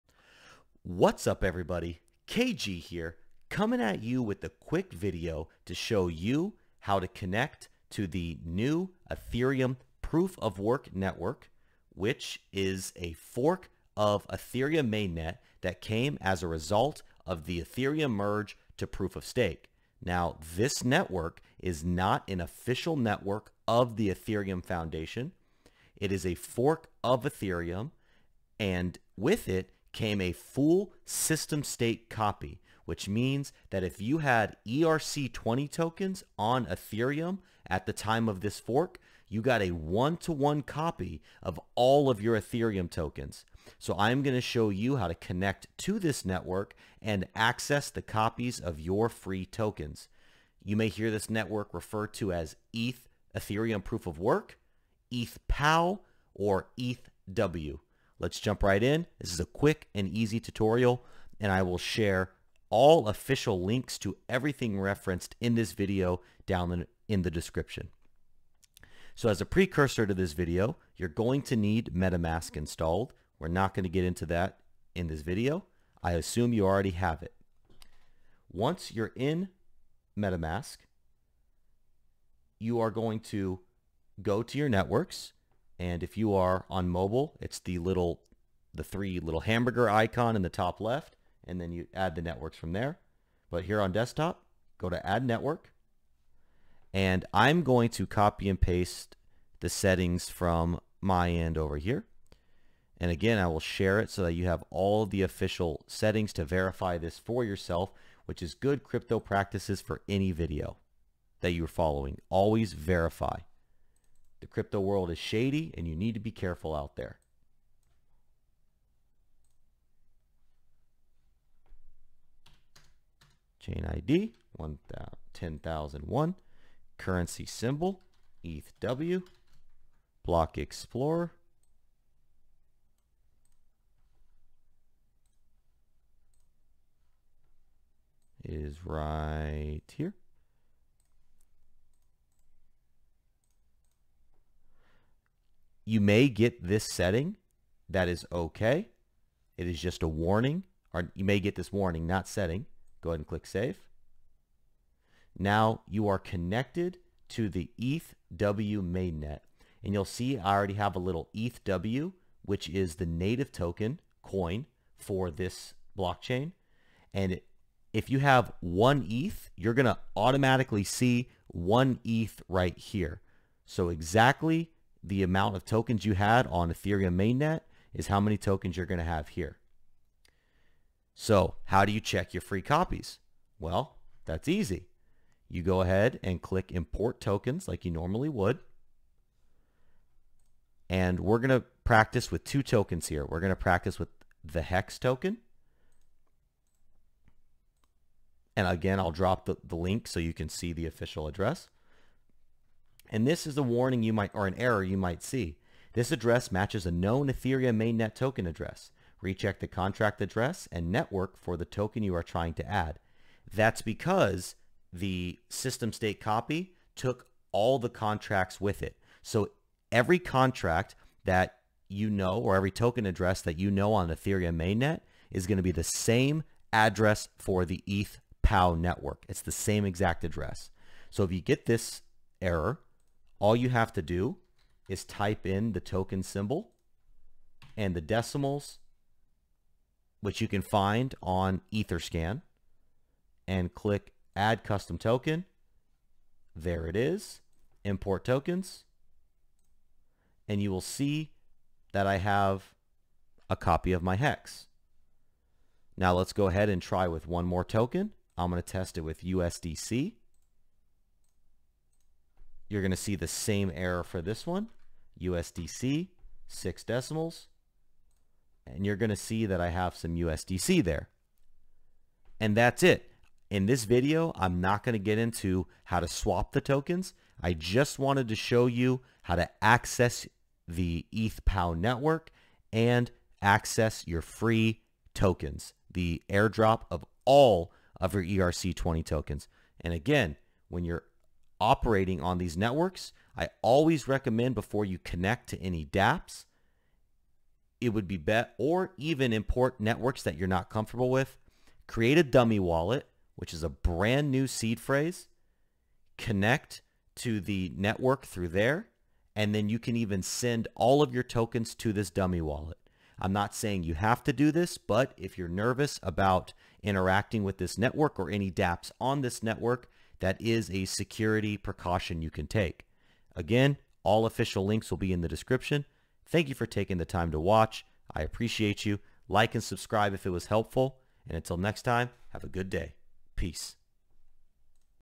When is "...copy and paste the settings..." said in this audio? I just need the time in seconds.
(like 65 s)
98 s.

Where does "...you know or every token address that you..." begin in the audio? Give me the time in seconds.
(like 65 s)
221 s.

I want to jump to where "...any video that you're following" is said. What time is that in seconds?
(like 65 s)
110 s.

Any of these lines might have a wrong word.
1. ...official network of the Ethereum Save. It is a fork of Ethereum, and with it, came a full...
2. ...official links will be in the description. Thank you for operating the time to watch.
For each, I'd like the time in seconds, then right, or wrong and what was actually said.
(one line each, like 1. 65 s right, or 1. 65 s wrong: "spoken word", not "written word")
1. 22 s wrong: "Foundation", not "Save"
2. 324 s wrong: "taking", not "operating".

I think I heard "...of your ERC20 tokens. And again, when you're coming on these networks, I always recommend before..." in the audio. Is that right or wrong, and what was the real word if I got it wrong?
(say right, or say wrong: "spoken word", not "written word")
wrong: "operating", not "coming".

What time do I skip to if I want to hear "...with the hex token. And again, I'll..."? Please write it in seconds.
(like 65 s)
193 s.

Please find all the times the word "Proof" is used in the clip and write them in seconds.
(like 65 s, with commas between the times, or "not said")
10 s, 18 s, 53 s.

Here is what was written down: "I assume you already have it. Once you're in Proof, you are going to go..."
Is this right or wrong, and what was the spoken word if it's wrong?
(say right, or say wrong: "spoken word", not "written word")
wrong: "MetaMask", not "Proof".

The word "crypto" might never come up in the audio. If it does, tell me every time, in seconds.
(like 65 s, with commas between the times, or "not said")
108 s, 114 s.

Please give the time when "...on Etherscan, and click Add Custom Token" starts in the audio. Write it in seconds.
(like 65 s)
241 s.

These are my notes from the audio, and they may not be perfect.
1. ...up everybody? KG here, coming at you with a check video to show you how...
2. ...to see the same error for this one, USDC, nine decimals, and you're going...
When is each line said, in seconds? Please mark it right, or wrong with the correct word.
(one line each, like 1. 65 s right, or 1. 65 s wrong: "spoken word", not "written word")
1. 1 s wrong: "quick", not "check"
2. 262 s wrong: "six", not "nine".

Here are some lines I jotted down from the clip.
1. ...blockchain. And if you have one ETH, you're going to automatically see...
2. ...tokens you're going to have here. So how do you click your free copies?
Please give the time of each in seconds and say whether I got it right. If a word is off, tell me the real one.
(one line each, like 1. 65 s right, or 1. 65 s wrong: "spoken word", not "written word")
1. 165 s right
2. 178 s wrong: "check", not "click".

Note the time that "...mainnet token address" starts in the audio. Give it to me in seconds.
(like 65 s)
207 s.